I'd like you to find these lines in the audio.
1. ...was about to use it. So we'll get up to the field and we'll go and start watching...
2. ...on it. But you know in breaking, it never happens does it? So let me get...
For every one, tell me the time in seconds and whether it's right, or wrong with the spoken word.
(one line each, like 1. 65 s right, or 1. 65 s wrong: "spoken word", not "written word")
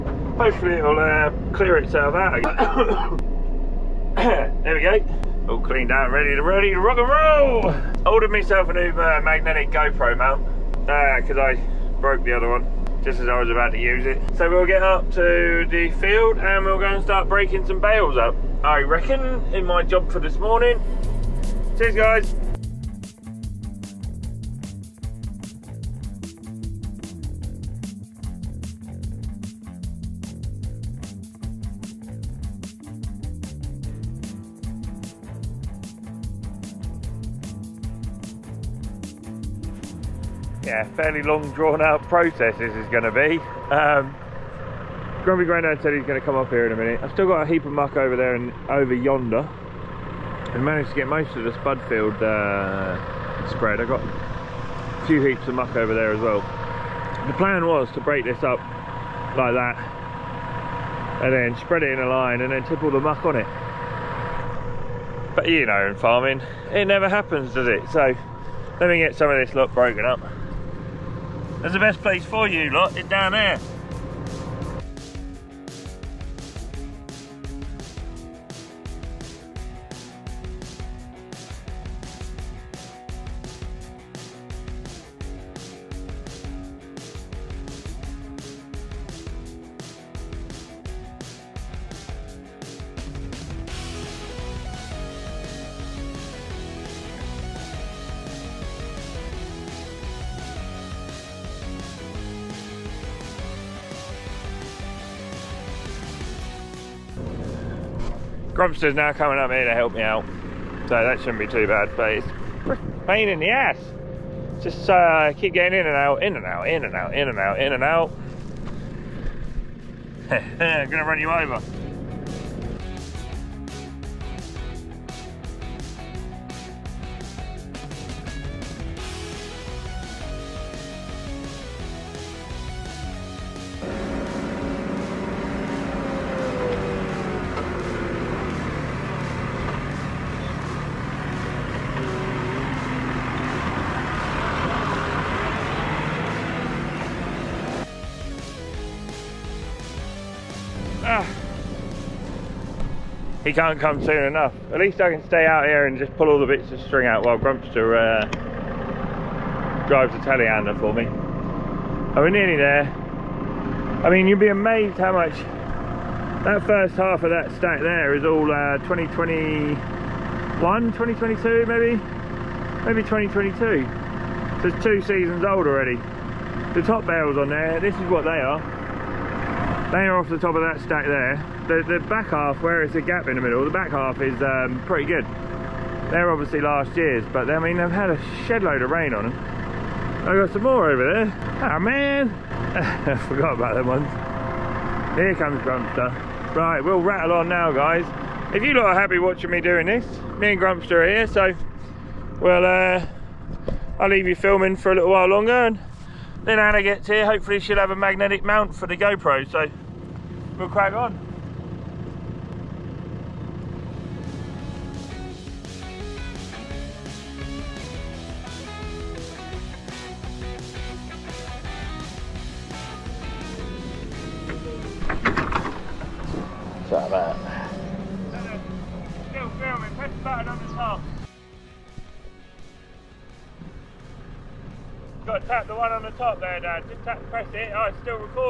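1. 13 s wrong: "breaking", not "watching"
2. 63 s wrong: "farming", not "breaking".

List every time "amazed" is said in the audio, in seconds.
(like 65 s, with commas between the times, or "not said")
164 s.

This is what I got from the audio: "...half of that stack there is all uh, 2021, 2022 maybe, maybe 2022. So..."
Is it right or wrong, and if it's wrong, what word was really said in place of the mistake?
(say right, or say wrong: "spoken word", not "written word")
right.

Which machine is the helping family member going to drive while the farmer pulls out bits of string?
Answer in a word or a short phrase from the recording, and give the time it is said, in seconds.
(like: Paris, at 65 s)
telehandler, at 160 s.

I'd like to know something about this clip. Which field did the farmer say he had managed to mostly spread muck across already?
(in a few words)
spud field.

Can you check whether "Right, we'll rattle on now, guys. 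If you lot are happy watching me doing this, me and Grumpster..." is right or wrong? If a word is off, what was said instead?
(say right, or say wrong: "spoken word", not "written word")
right.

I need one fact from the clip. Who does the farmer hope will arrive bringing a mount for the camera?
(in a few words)
Anna.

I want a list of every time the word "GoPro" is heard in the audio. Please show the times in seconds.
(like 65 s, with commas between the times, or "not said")
9 s, 208 s.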